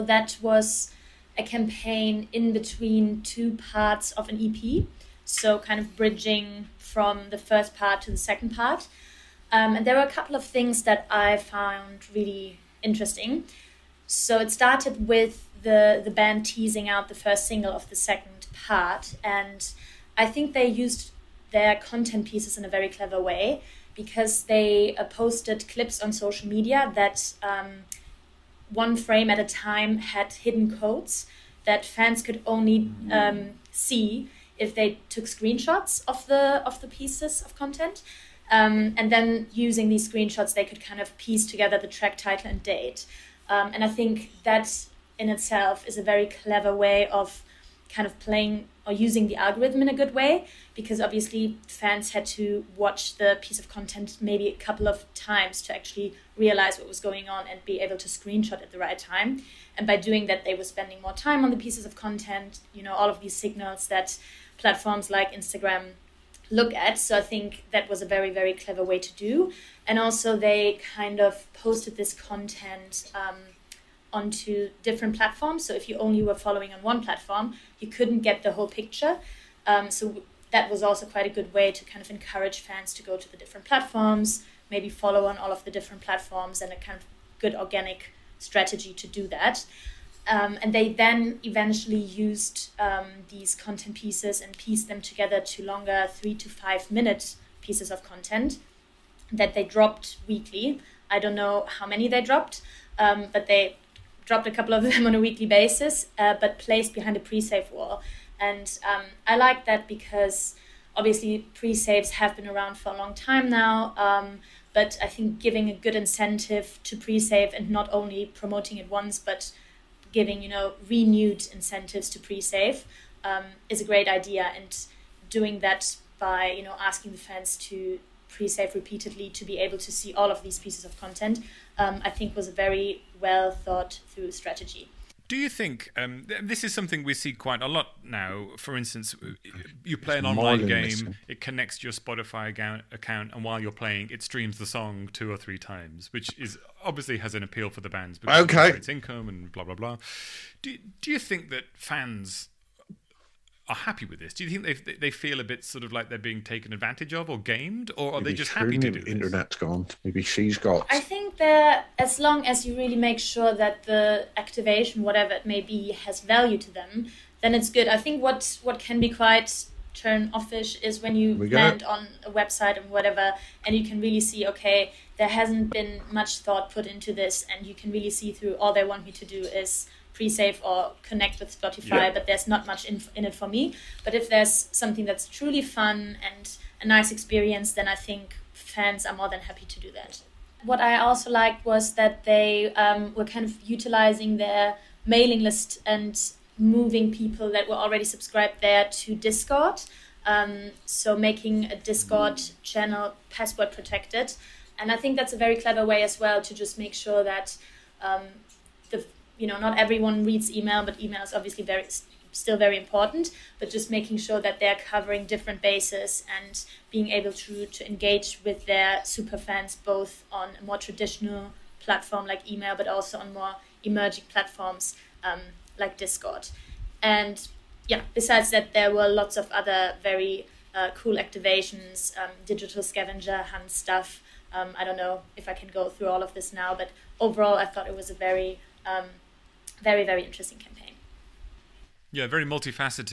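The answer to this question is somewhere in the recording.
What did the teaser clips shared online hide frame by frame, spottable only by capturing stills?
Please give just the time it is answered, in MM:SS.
00:30.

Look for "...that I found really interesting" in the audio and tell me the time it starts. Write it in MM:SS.
00:10.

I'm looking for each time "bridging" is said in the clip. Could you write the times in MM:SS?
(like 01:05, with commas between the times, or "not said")
00:05.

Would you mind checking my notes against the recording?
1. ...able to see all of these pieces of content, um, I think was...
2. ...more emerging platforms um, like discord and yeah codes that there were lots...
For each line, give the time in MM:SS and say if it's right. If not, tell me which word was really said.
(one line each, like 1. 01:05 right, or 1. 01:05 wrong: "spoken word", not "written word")
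1. 02:09 right
2. 03:43 wrong: "besides", not "codes".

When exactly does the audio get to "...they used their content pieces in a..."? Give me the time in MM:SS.
00:20.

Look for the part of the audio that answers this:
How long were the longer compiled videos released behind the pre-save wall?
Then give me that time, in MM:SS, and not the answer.
01:36.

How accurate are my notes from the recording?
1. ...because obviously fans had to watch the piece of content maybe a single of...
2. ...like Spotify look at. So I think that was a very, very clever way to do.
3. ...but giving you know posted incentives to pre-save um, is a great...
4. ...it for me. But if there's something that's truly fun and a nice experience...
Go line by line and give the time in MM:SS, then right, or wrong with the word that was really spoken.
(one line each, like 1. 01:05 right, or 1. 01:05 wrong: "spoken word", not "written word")
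1. 00:50 wrong: "couple", not "single"
2. 01:05 wrong: "Instagram", not "Spotify"
3. 01:59 wrong: "renewed", not "posted"
4. 03:03 right.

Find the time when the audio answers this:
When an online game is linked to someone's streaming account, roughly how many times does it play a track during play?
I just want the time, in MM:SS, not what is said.
02:25.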